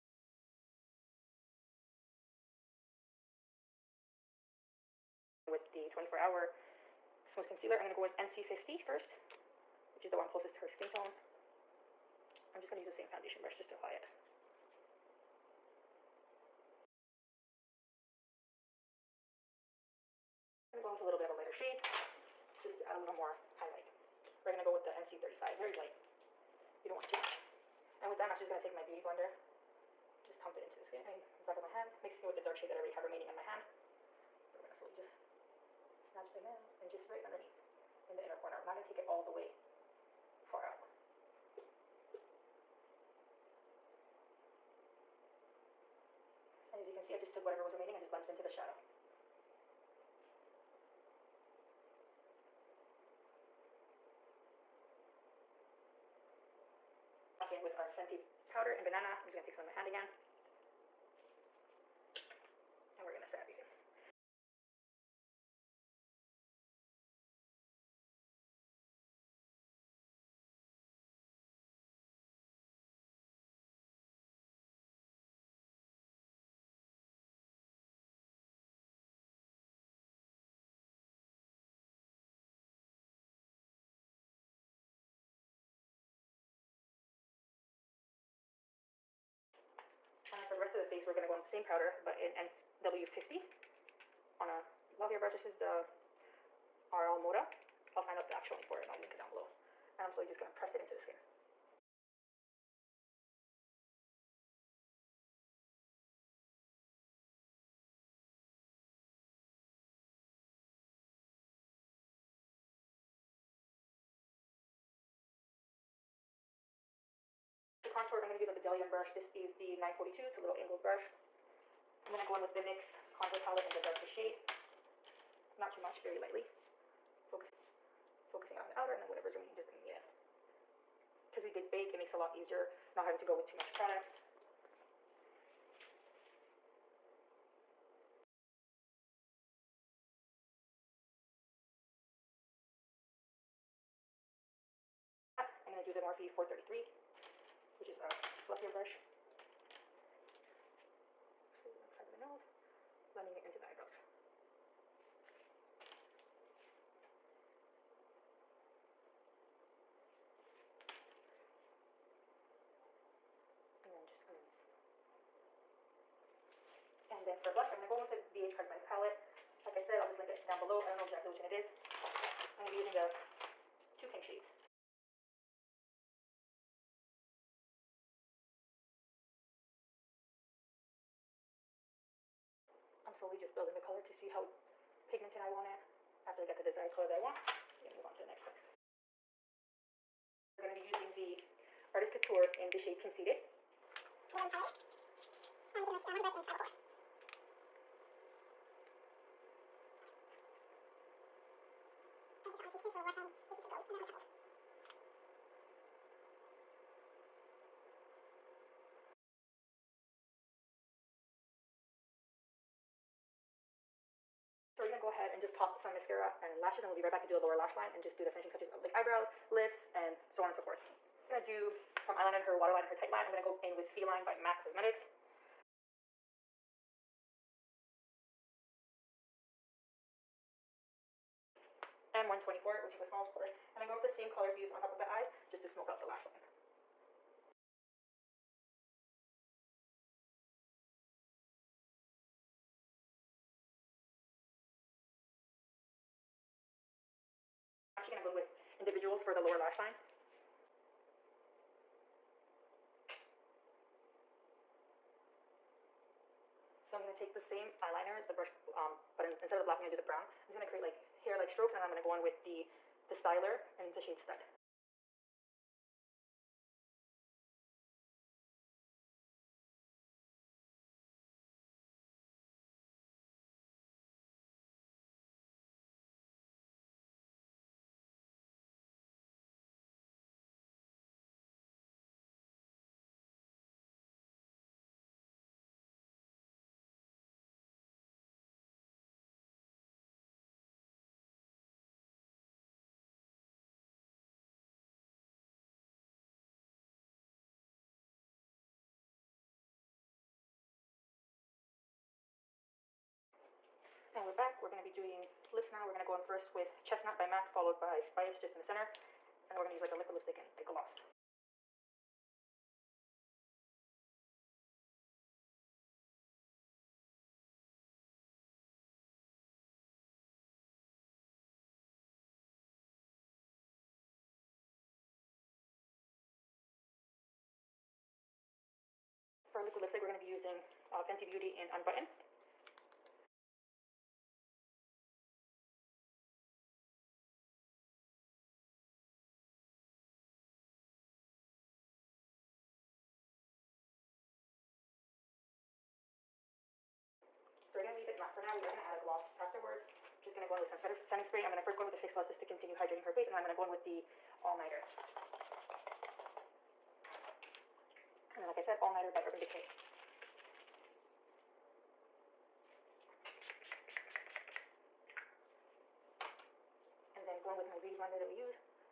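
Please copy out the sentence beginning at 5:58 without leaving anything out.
And then, like I said, All Nighter by Urban Decay.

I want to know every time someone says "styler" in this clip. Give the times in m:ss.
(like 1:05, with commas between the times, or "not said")
4:23.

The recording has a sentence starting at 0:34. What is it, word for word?
I'm gonna slowly just snatch them in and just right underneath in the inner corner.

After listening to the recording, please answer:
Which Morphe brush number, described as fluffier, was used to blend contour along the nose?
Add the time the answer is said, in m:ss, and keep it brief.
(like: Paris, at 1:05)
433, at 2:26.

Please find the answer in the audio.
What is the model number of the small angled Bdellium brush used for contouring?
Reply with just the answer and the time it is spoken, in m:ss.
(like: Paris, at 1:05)
942, at 1:59.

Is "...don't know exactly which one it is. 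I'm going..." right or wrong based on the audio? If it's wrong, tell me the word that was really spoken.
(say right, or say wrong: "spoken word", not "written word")
right.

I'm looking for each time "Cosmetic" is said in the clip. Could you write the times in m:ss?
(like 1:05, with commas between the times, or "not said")
2:48, 3:44.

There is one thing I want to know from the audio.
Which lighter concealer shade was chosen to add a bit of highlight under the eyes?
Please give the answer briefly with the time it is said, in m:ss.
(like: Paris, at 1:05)
NC35, at 0:24.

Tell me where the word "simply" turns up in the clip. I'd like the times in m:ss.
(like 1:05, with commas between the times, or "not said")
not said.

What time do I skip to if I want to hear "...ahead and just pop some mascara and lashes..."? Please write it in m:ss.
3:35.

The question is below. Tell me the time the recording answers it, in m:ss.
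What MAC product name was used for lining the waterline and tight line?
3:43.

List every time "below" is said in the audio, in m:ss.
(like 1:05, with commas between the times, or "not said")
1:39, 2:50.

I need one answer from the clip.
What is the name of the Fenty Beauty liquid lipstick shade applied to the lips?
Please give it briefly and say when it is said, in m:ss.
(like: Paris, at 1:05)
Unbutton, at 5:31.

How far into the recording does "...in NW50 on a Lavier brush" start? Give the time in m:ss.
1:32.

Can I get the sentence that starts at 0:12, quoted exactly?
I'm just going to use the same foundation brush just to apply it.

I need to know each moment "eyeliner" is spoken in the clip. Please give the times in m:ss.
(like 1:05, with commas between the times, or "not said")
3:42, 4:17.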